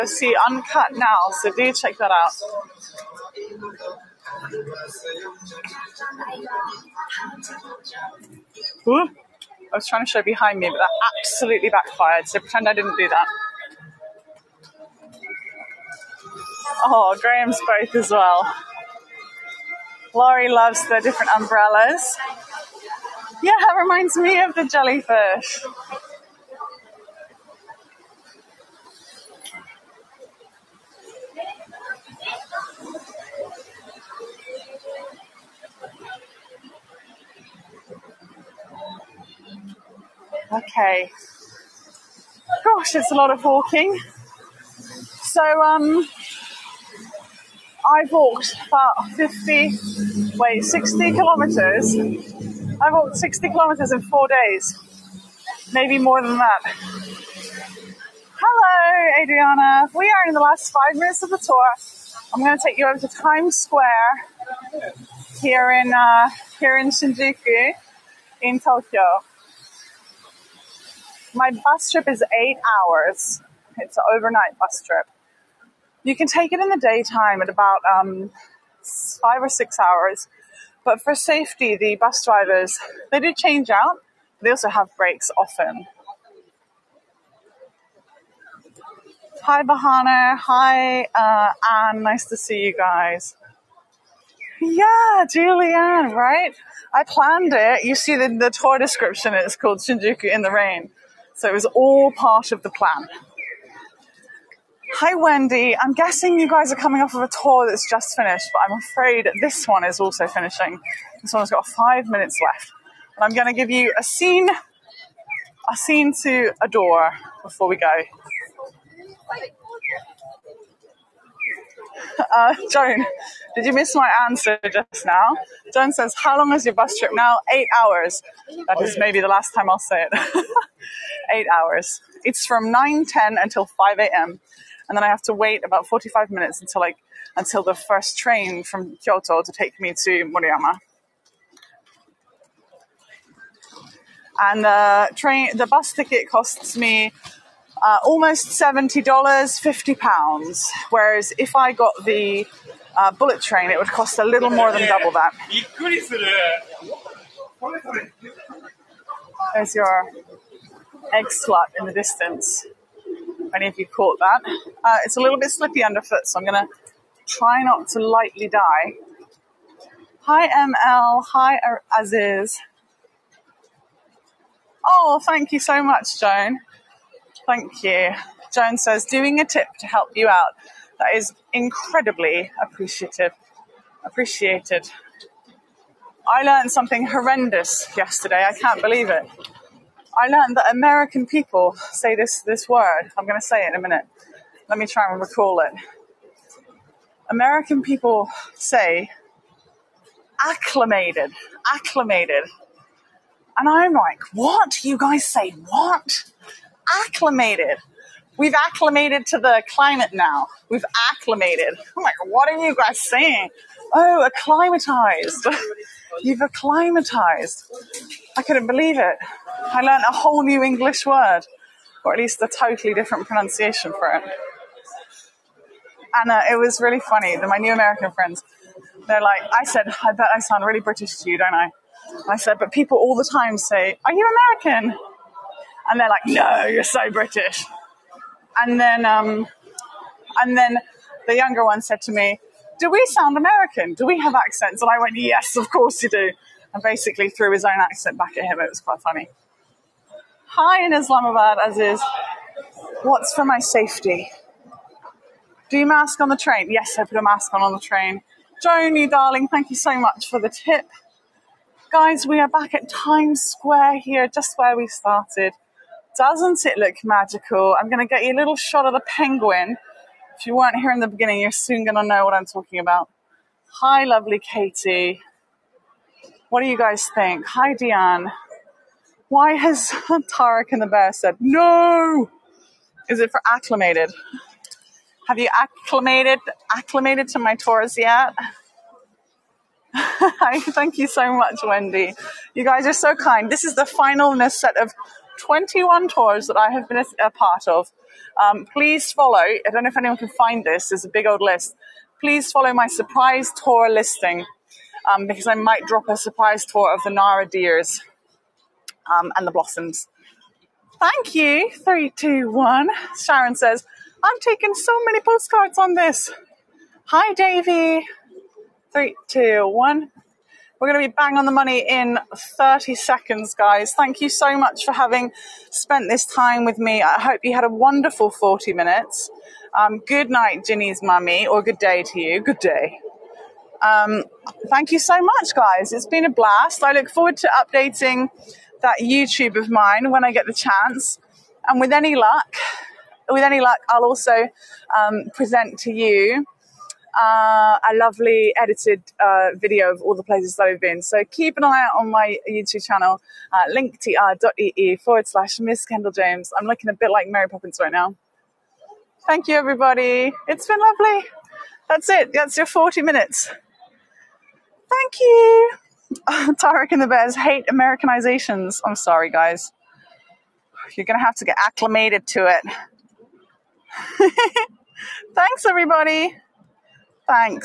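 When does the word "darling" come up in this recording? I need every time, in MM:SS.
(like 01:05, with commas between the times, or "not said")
04:19.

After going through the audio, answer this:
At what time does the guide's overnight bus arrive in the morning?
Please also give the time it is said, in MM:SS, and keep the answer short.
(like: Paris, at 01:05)
5 a.m., at 02:13.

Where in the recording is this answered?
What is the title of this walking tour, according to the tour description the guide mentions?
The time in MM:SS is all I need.
01:39.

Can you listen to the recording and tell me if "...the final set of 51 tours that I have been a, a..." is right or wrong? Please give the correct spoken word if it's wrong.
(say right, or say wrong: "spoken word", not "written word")
wrong: "21", not "51".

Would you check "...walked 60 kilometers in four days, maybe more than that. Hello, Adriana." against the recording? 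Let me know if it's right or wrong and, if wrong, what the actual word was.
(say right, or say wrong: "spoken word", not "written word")
right.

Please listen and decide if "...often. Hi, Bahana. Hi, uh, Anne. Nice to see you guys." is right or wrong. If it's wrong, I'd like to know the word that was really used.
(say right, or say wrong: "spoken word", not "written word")
right.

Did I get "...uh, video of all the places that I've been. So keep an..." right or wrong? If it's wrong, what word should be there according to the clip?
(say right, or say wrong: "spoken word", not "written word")
right.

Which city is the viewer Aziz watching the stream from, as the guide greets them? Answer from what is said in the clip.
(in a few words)
Islamabad.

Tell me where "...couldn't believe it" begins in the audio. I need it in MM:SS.
03:38.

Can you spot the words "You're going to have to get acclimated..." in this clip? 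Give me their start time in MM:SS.
06:10.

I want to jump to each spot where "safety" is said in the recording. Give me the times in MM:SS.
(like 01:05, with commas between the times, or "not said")
01:21, 04:13.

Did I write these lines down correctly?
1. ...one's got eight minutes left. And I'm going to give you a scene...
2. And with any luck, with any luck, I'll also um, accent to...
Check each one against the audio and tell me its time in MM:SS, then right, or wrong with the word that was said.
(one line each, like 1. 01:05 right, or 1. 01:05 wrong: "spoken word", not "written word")
1. 01:51 wrong: "five", not "eight"
2. 05:41 wrong: "present", not "accent".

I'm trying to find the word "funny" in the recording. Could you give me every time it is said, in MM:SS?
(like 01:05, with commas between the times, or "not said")
03:47, 04:09.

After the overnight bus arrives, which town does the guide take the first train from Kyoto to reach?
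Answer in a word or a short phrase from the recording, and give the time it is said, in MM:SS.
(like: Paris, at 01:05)
Moriyama, at 02:20.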